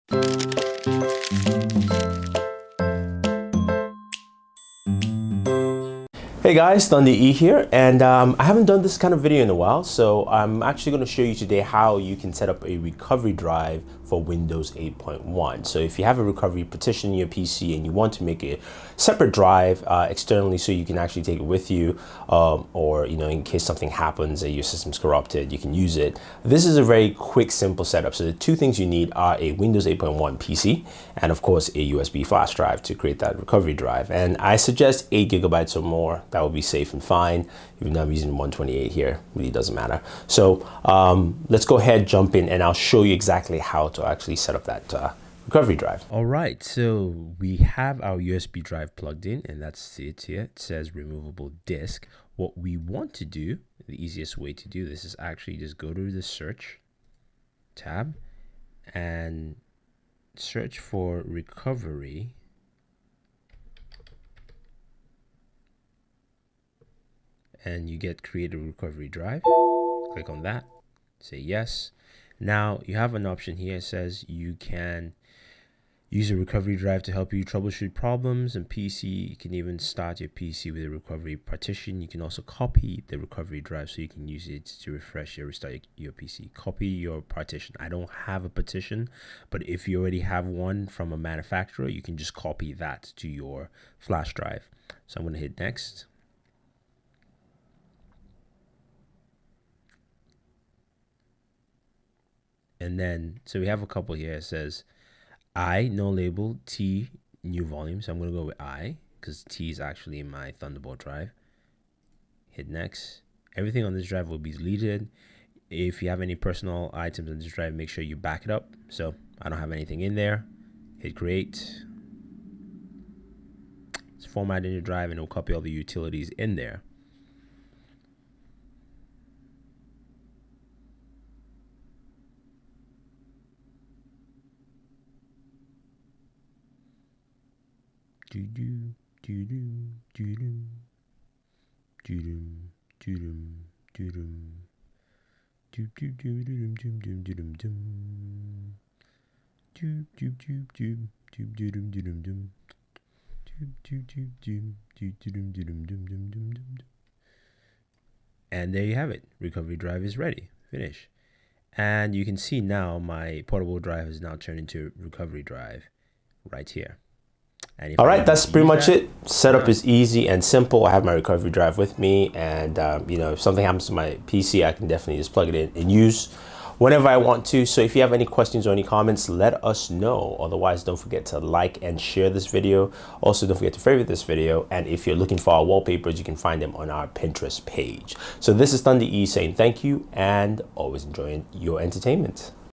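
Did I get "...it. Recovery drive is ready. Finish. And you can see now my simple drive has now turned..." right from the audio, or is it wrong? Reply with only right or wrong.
wrong.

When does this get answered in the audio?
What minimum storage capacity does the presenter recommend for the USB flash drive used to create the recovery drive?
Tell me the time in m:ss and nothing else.
0:35.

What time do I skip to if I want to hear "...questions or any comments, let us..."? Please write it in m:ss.
2:58.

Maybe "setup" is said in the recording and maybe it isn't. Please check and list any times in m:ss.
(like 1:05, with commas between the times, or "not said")
0:27, 2:49.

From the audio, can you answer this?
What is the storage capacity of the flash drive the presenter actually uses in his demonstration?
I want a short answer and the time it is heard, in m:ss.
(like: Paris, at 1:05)
128, at 0:38.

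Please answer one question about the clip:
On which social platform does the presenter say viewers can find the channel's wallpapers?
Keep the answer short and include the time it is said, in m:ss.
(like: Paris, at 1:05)
Pinterest, at 3:07.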